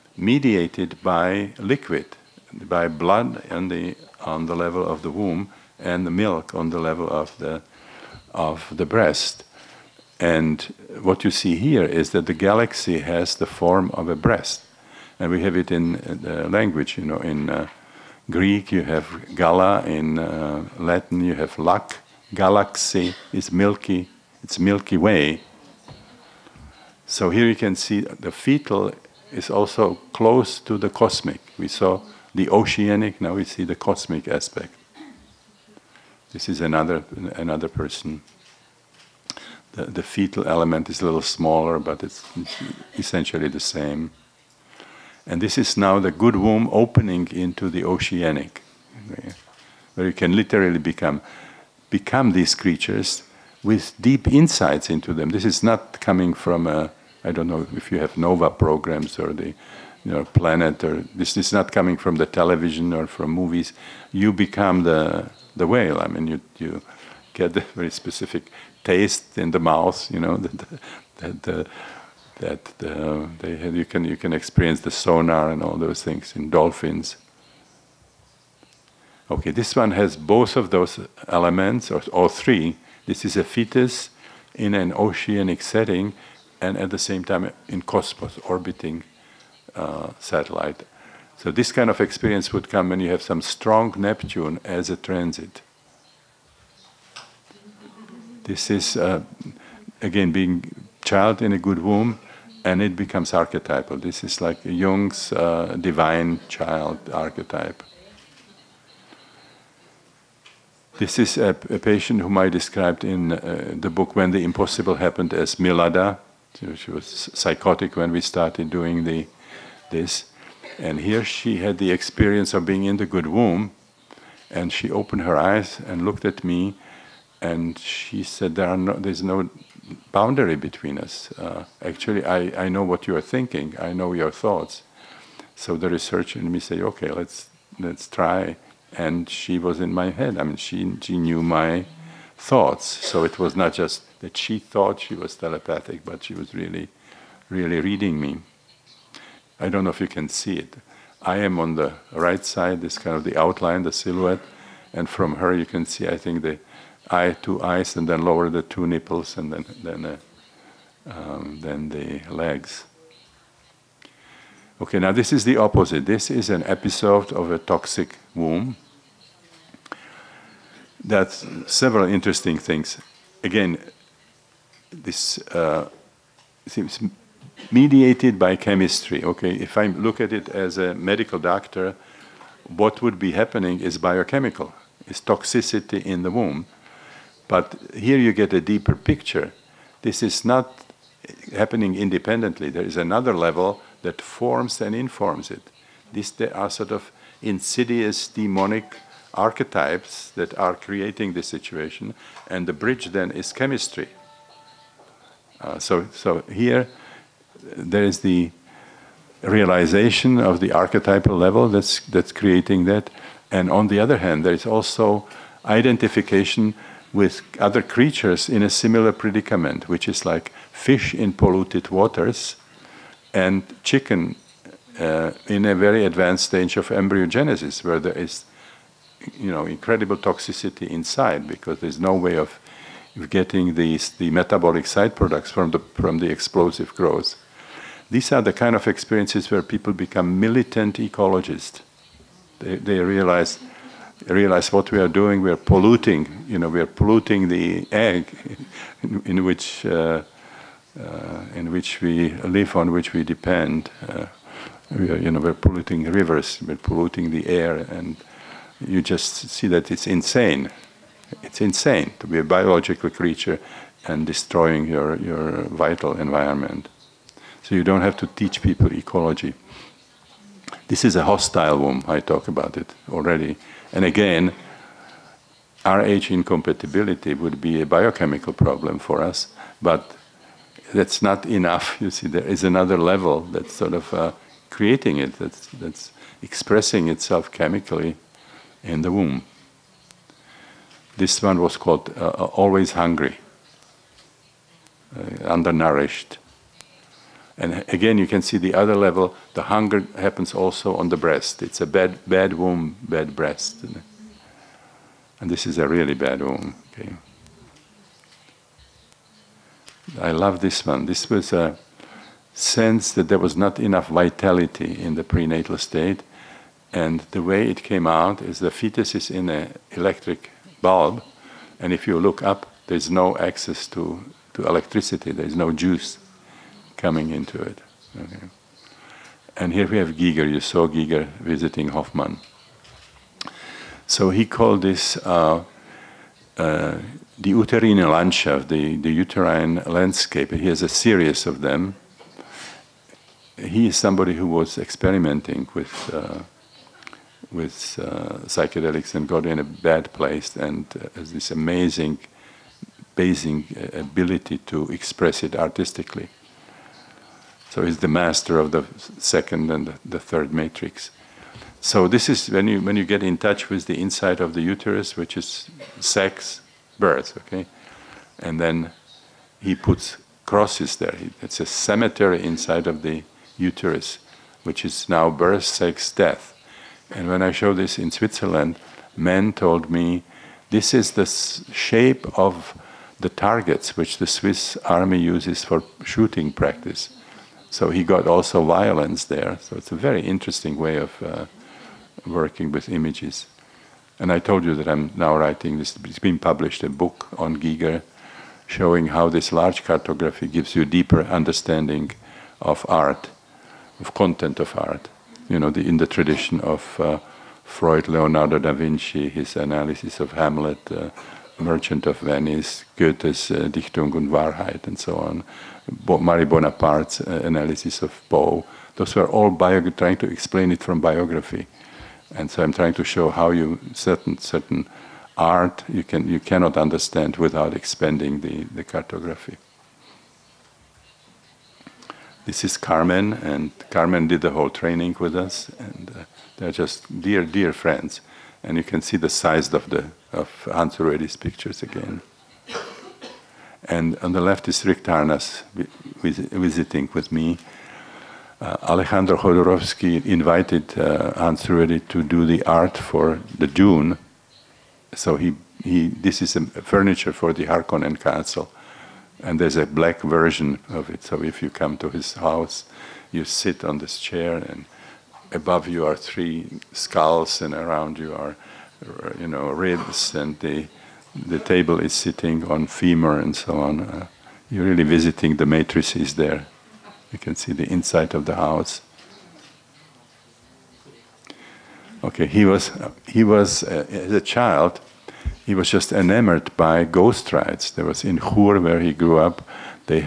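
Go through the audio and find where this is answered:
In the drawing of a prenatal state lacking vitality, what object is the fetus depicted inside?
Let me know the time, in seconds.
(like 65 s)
319 s.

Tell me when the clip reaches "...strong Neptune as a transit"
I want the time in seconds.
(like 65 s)
93 s.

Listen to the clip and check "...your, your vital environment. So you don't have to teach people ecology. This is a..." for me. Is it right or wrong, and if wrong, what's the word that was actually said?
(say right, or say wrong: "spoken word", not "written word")
right.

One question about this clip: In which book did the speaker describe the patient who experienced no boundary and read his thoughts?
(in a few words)
When the Impossible Happened.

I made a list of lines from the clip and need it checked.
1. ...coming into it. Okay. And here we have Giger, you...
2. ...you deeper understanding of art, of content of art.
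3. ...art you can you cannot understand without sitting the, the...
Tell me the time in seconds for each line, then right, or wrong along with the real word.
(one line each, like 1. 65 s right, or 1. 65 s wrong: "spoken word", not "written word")
1. 326 s right
2. 400 s right
3. 425 s wrong: "expanding", not "sitting".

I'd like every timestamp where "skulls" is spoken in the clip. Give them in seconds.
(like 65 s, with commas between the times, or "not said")
466 s.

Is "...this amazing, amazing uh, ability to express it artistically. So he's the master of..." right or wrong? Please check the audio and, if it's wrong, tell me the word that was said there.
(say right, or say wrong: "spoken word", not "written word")
right.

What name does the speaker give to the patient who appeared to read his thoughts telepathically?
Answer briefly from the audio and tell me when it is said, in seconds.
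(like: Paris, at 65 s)
Milada, at 115 s.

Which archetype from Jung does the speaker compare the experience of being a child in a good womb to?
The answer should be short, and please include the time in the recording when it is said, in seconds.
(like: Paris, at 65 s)
divine child, at 105 s.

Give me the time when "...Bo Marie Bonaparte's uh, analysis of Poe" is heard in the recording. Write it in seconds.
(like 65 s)
415 s.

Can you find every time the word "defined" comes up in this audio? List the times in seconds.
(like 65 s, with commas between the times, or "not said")
not said.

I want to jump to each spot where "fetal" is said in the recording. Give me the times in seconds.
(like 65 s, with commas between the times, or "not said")
28 s, 40 s.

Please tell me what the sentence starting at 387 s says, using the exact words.
So he got also violence there.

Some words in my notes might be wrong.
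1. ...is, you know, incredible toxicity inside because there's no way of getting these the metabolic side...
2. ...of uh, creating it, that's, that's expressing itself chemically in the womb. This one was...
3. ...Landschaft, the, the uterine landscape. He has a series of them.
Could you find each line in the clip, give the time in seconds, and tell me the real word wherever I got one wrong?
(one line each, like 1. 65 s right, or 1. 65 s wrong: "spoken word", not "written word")
1. 228 s right
2. 283 s right
3. 337 s right.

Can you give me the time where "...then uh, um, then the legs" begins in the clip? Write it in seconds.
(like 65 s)
159 s.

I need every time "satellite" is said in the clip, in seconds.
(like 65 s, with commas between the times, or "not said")
90 s.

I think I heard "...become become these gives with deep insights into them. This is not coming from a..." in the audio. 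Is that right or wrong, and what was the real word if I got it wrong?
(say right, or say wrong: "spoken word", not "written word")
wrong: "creatures", not "gives".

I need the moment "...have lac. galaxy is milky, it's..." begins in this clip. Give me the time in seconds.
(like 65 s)
21 s.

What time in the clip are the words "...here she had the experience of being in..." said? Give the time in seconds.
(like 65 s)
121 s.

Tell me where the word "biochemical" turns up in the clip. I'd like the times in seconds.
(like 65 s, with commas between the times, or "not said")
183 s, 277 s.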